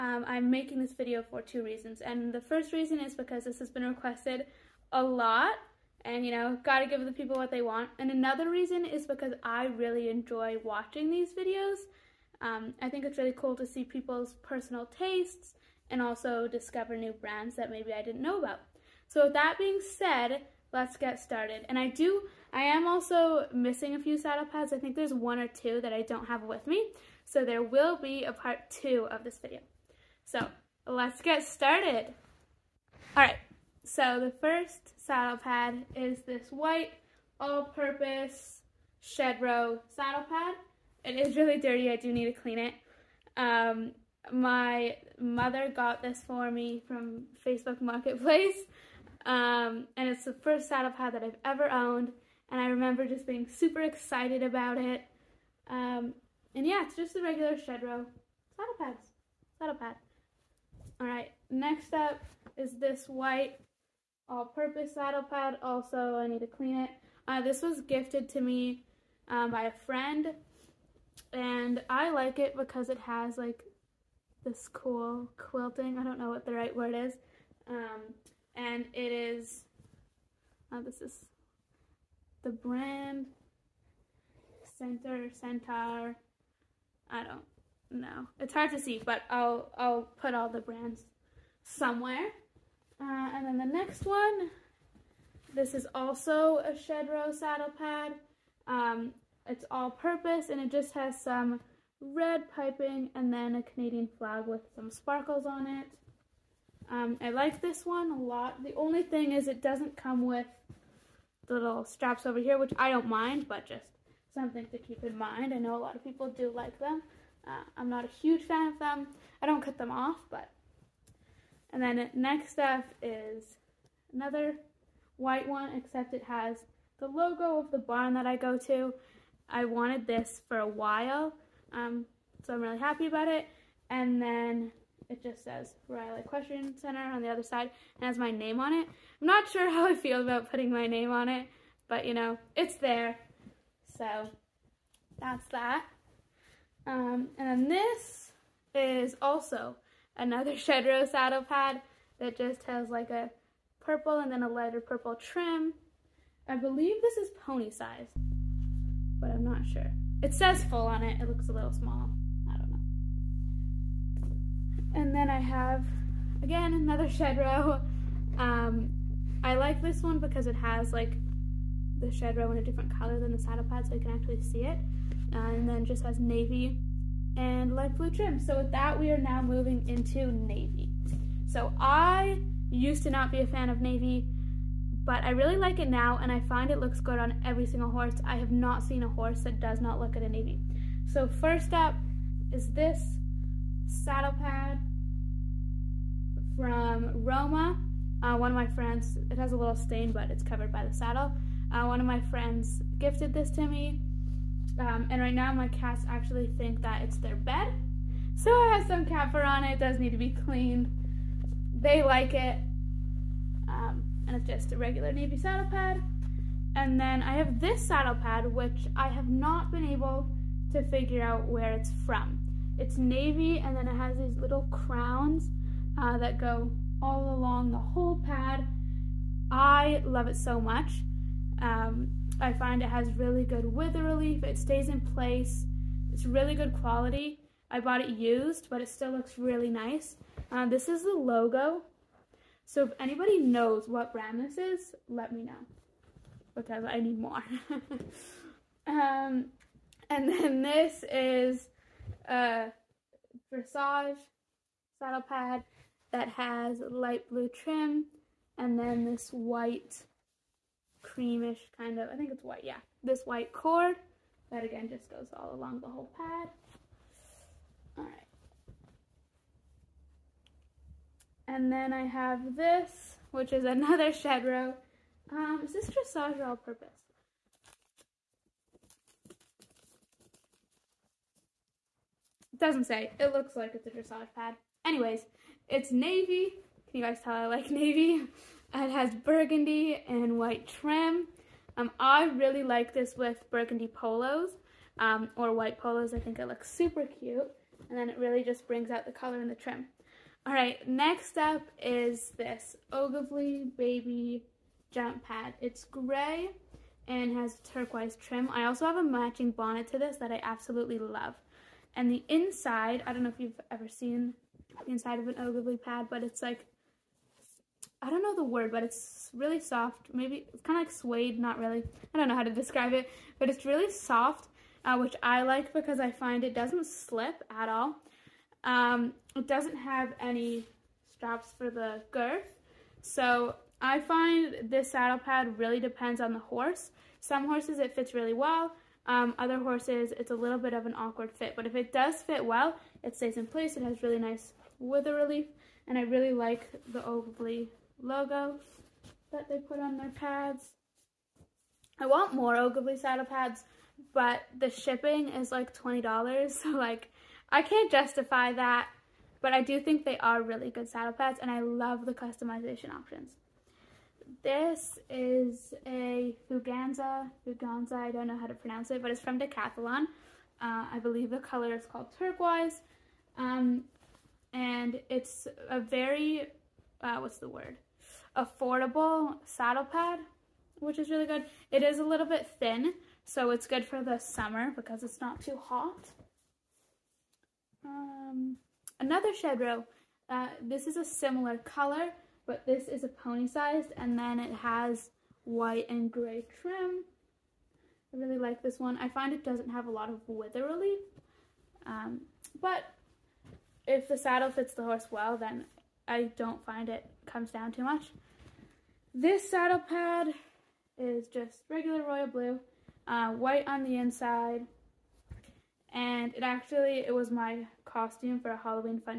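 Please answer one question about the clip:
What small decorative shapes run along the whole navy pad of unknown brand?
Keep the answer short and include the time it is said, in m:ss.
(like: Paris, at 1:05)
crowns, at 3:44.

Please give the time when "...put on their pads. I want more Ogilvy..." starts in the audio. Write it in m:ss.
5:49.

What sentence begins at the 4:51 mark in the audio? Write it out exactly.
Um, I really like this with burgundy polos um, or white polos.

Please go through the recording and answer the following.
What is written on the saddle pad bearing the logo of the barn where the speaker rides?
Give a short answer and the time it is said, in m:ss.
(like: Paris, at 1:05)
Riley Equestrian Center, at 2:15.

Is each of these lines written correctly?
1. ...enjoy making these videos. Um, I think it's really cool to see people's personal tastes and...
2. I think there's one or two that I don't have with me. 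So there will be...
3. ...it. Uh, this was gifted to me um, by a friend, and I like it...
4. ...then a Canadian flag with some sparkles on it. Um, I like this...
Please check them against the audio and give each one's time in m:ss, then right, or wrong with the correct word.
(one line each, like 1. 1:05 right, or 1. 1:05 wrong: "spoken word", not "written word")
1. 0:10 wrong: "watching", not "making"
2. 0:24 right
3. 1:06 right
4. 1:43 right.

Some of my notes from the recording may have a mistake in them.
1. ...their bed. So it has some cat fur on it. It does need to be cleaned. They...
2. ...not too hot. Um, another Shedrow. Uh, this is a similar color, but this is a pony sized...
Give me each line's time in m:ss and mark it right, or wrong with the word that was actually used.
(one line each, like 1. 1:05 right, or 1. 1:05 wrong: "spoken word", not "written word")
1. 3:27 right
2. 6:25 right.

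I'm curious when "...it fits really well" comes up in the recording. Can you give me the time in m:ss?
5:37.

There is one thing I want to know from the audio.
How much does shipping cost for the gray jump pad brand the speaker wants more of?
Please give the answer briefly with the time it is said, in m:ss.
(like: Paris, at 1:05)
$20, at 5:55.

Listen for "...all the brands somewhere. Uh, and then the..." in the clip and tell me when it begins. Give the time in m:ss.
1:30.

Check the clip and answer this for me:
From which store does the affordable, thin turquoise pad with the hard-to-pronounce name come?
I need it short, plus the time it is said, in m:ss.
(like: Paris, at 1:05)
Decathlon, at 6:09.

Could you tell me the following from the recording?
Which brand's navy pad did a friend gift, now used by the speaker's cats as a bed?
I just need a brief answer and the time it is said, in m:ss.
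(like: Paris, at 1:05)
Roma, at 3:17.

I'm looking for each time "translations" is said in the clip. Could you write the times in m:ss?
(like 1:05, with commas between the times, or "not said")
not said.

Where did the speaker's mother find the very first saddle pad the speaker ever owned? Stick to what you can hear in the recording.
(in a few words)
Facebook Marketplace.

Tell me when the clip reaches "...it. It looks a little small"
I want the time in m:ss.
2:41.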